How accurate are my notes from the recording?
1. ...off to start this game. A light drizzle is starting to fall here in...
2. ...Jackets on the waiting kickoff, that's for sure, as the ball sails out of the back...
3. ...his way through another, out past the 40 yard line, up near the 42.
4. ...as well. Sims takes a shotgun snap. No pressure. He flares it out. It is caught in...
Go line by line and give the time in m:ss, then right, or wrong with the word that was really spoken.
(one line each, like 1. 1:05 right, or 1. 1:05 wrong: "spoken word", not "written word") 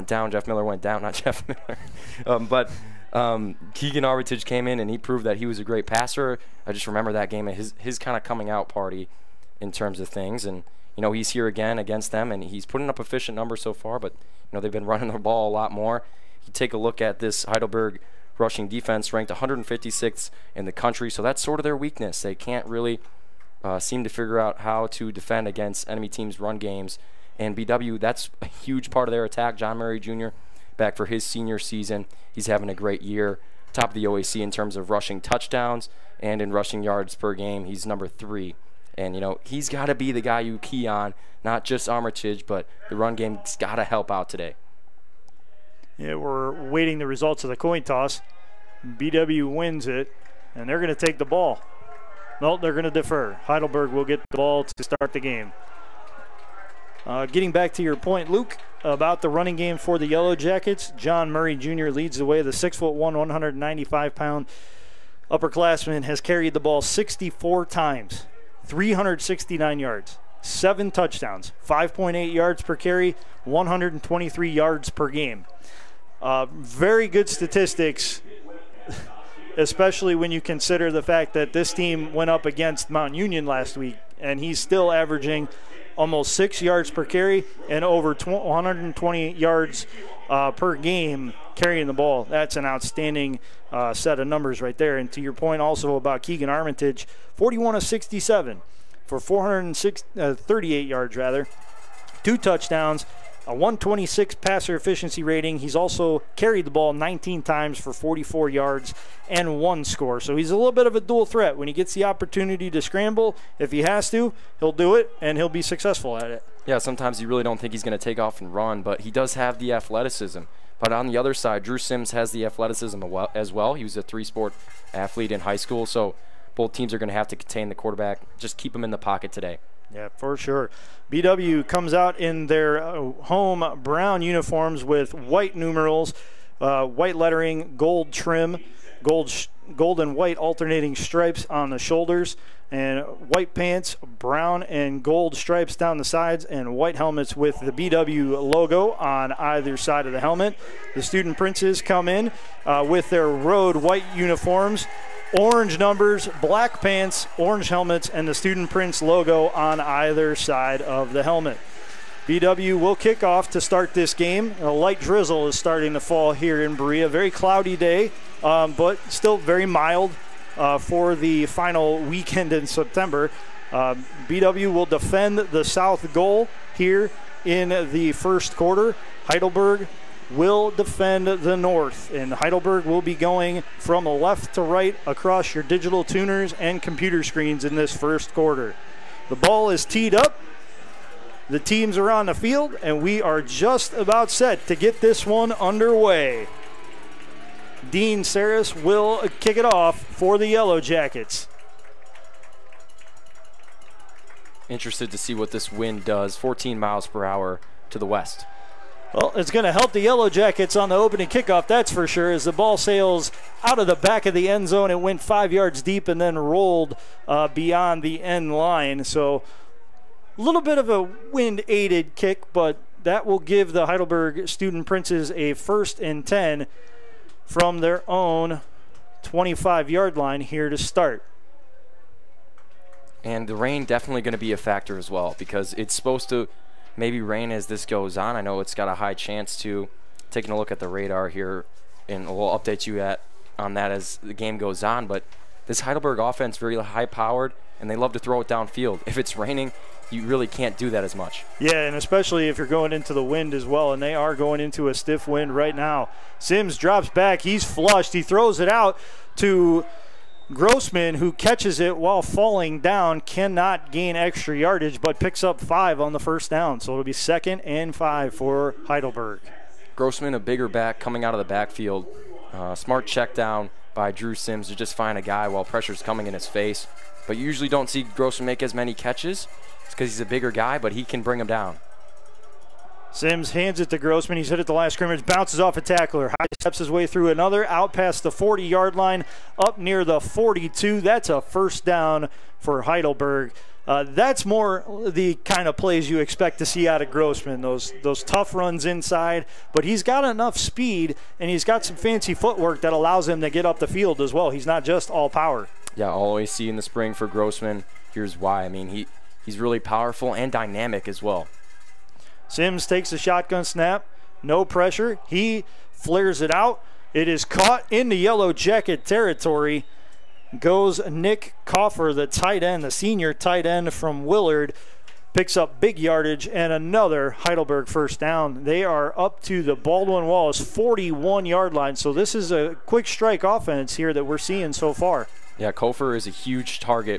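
1. 2:43 right
2. 3:30 wrong: "opening", not "waiting"
3. 4:46 right
4. 5:11 right.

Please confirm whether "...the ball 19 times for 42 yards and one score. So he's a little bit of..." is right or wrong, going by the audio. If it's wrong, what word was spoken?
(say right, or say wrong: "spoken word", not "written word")
wrong: "44", not "42".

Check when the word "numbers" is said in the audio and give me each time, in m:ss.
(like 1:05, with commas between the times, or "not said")
0:13, 0:37, 1:34, 2:35.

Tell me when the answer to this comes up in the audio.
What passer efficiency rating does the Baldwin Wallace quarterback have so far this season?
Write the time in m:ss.
1:43.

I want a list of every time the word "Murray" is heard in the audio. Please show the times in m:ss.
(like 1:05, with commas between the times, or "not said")
0:29, 1:01.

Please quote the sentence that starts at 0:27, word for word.
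And BW, that's a huge part of their attack.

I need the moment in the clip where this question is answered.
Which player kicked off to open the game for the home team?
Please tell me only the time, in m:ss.
3:17.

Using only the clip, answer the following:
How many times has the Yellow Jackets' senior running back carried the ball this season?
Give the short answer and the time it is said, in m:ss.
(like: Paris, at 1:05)
64, at 1:06.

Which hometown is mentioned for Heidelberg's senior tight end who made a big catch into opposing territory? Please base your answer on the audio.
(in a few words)
Willard.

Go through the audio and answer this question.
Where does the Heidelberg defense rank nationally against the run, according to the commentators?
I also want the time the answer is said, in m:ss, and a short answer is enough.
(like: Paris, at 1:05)
156th, at 0:19.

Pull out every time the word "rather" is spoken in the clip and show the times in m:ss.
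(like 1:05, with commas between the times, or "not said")
1:41.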